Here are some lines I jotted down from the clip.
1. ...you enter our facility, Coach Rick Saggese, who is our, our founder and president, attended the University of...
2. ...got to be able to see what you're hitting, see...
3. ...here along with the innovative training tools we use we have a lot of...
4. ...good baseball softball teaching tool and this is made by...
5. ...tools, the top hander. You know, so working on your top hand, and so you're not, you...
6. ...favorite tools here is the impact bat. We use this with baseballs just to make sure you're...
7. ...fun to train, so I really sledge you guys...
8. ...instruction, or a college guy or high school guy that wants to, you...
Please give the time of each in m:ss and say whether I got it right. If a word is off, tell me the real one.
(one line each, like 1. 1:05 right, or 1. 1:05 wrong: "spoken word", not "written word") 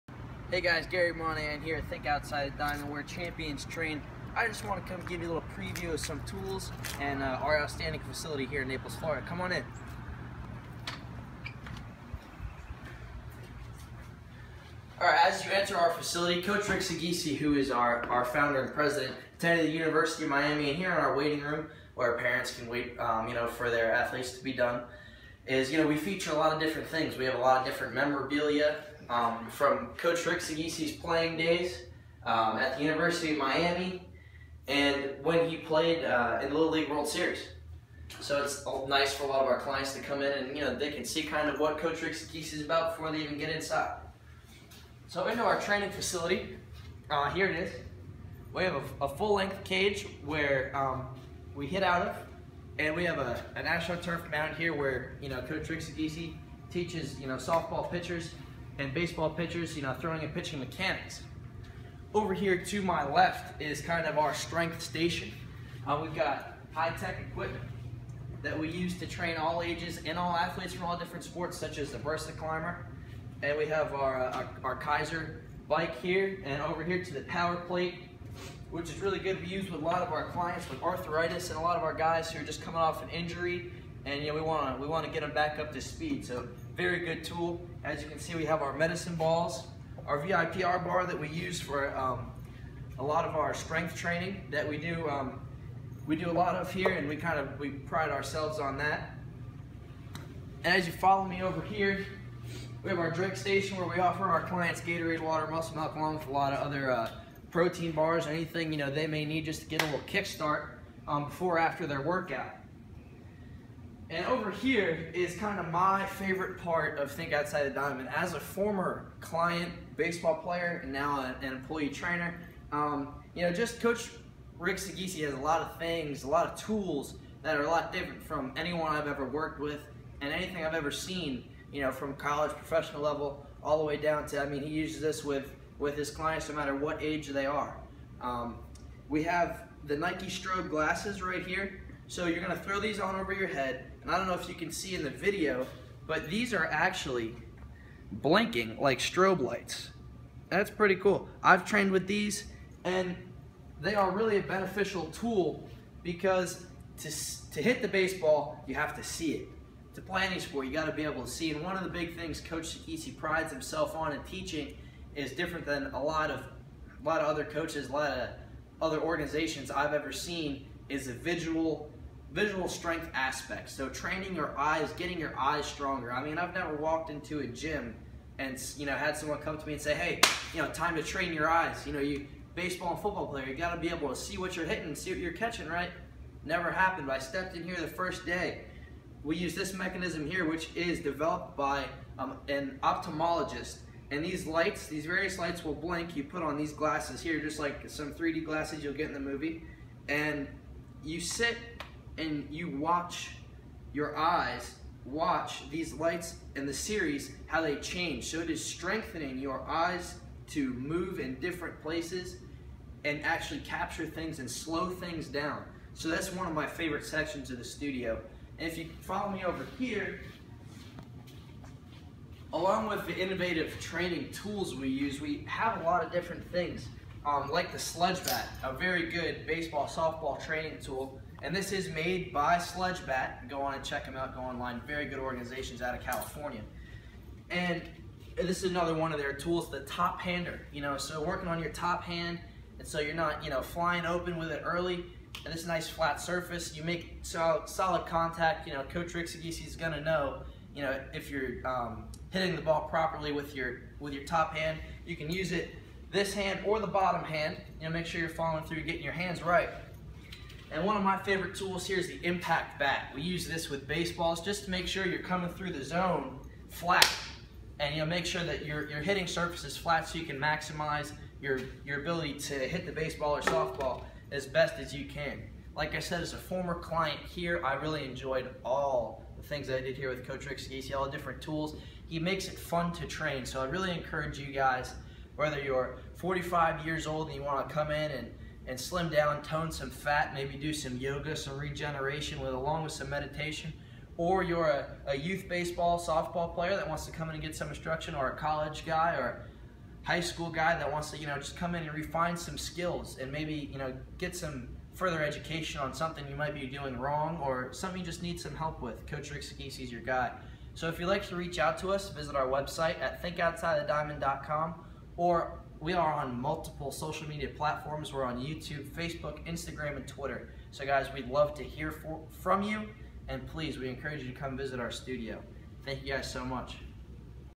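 1. 0:15 right
2. 3:03 right
3. 3:39 right
4. 3:49 wrong: "training", not "teaching"
5. 3:59 right
6. 4:21 right
7. 4:42 wrong: "encourage", not "sledge"
8. 4:57 right.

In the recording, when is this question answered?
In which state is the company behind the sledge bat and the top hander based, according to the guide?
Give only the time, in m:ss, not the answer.
3:56.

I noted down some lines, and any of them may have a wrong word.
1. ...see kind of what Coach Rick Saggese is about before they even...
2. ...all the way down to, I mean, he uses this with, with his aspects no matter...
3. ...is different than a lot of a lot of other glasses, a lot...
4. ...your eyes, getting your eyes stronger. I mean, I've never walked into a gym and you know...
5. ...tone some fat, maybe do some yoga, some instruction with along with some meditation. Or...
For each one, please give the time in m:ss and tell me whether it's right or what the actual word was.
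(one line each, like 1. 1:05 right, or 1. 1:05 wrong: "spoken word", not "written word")
1. 0:41 right
2. 2:13 wrong: "clients", not "aspects"
3. 2:45 wrong: "coaches", not "glasses"
4. 2:54 right
5. 4:49 wrong: "regeneration", not "instruction".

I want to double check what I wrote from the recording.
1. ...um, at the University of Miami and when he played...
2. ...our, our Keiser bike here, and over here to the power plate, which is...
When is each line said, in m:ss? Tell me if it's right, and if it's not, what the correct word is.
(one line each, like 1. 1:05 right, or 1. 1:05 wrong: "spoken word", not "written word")
1. 0:32 right
2. 1:14 right.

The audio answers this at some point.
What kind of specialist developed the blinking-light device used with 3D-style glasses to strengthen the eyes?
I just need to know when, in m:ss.
3:12.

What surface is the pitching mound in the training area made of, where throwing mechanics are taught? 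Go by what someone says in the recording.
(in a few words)
AstroTurf.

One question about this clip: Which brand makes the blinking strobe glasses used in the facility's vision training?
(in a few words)
Nike.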